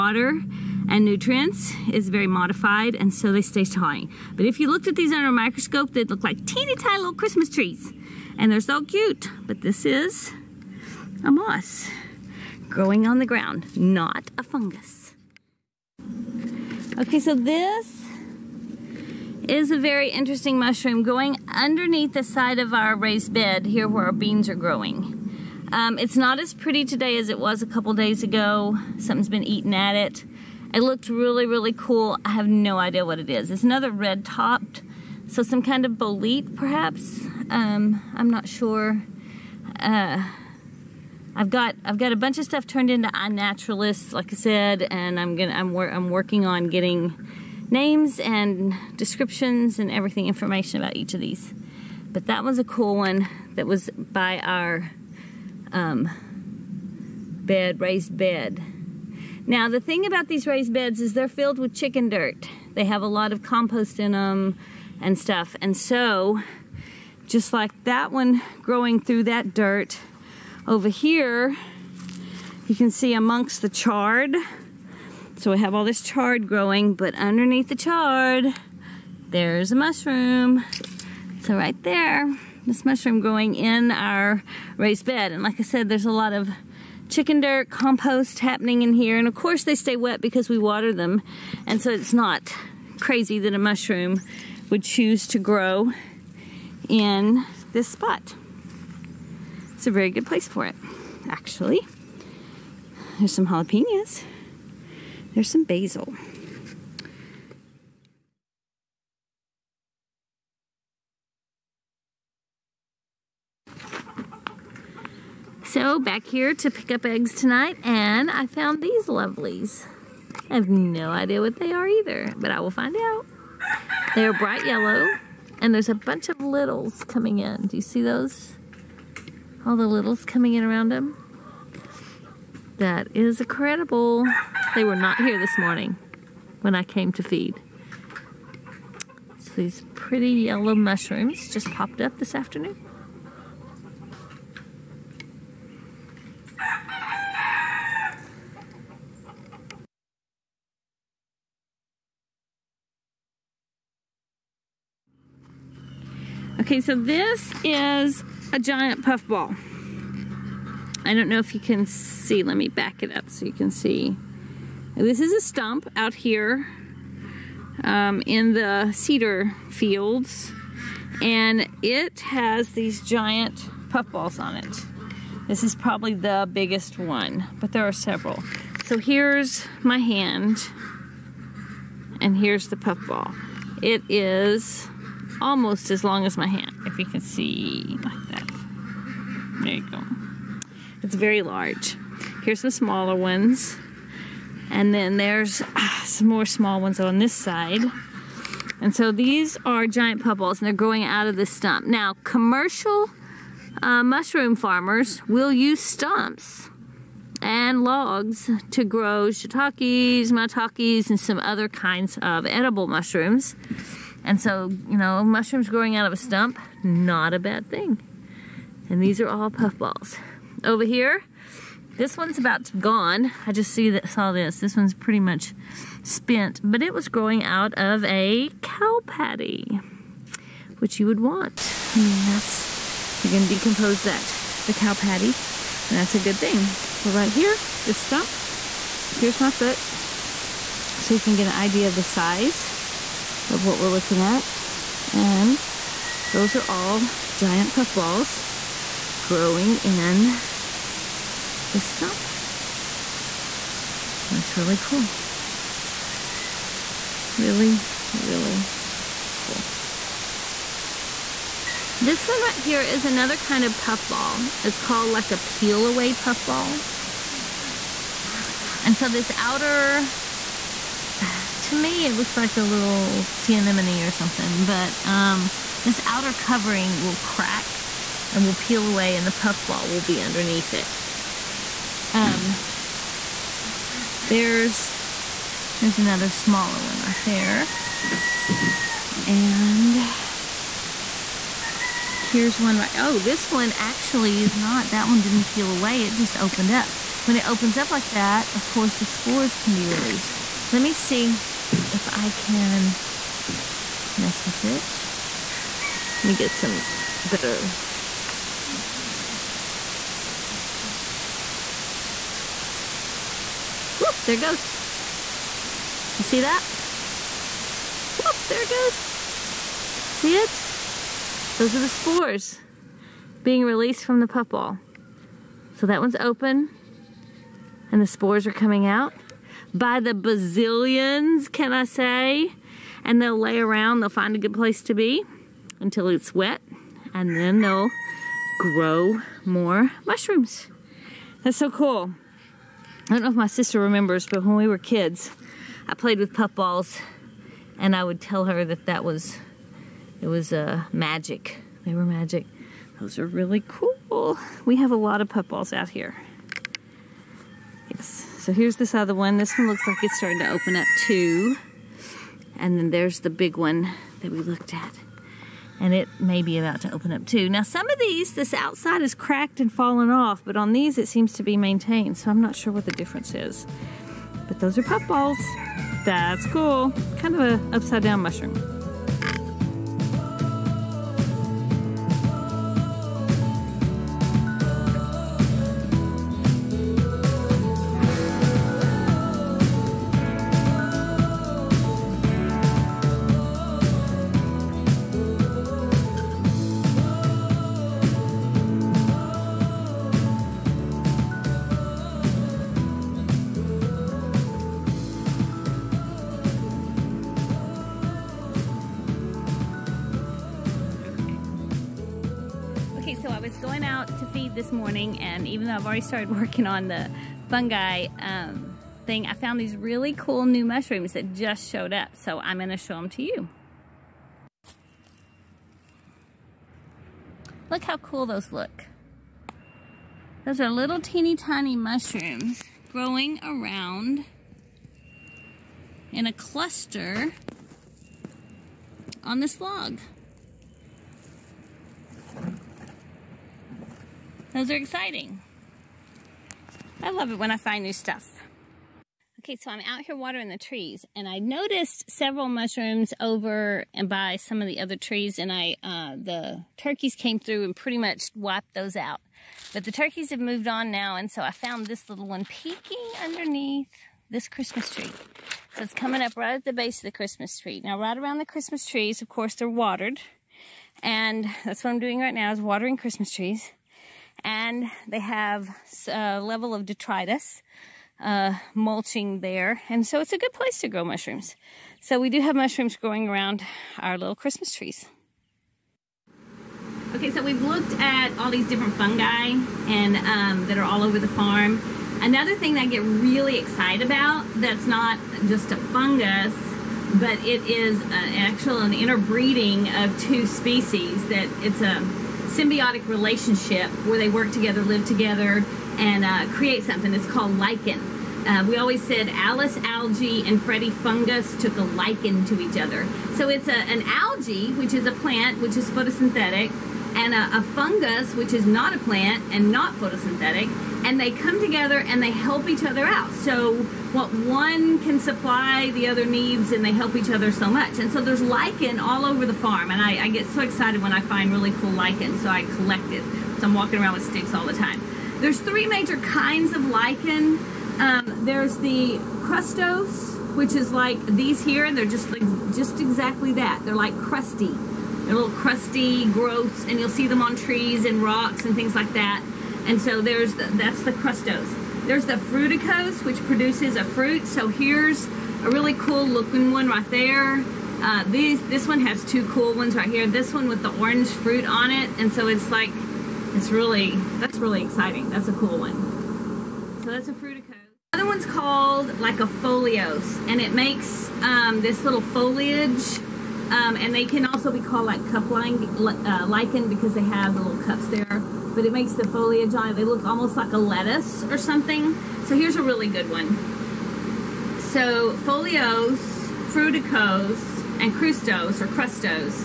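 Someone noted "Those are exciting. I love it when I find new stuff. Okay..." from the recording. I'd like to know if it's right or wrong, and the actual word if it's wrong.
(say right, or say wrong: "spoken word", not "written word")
right.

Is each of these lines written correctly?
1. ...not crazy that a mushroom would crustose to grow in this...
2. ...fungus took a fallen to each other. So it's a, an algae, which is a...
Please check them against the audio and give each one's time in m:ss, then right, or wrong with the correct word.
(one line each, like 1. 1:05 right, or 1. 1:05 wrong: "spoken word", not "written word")
1. 1:32 wrong: "choose", not "crustose"
2. 8:30 wrong: "lichen", not "fallen".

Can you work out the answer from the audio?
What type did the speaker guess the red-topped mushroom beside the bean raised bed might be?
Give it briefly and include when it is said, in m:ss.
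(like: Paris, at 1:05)
bolete, at 0:35.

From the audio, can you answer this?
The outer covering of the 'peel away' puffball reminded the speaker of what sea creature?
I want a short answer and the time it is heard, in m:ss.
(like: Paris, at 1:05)
sea anemone, at 4:33.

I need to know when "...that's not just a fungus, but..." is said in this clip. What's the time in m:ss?
8:14.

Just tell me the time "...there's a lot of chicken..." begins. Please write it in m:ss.
1:25.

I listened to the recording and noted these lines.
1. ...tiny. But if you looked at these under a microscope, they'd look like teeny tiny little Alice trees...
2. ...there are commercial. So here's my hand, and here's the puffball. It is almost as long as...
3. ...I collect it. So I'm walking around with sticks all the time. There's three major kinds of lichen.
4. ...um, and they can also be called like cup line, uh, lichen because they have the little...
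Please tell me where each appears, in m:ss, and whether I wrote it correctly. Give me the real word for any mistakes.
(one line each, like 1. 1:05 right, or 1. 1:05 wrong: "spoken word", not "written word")
1. 0:03 wrong: "Christmas", not "Alice"
2. 2:57 wrong: "several", not "commercial"
3. 8:52 right
4. 9:33 right.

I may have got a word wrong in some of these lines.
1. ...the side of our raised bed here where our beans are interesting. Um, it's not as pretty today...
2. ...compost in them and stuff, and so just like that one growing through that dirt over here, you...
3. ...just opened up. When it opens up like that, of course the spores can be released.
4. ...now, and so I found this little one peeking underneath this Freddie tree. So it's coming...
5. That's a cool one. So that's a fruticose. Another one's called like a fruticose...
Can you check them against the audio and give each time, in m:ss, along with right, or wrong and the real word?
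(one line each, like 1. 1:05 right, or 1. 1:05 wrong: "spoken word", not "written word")
1. 0:22 wrong: "growing", not "interesting"
2. 1:03 right
3. 4:56 right
4. 7:40 wrong: "Christmas", not "Freddie"
5. 9:25 wrong: "foliose", not "fruticose".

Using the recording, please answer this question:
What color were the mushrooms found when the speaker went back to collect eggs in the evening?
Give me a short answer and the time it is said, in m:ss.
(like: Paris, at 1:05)
bright yellow, at 2:04.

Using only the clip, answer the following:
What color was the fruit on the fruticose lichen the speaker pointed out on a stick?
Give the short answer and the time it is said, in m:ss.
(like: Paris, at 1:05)
orange, at 9:20.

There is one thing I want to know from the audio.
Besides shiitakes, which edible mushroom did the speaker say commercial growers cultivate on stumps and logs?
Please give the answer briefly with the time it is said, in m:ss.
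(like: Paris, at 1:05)
maitakes, at 3:30.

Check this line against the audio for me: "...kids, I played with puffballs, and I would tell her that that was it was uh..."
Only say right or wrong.
right.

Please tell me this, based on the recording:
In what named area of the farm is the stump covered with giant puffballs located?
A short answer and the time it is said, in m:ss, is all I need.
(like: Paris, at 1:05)
cedar fields, at 2:48.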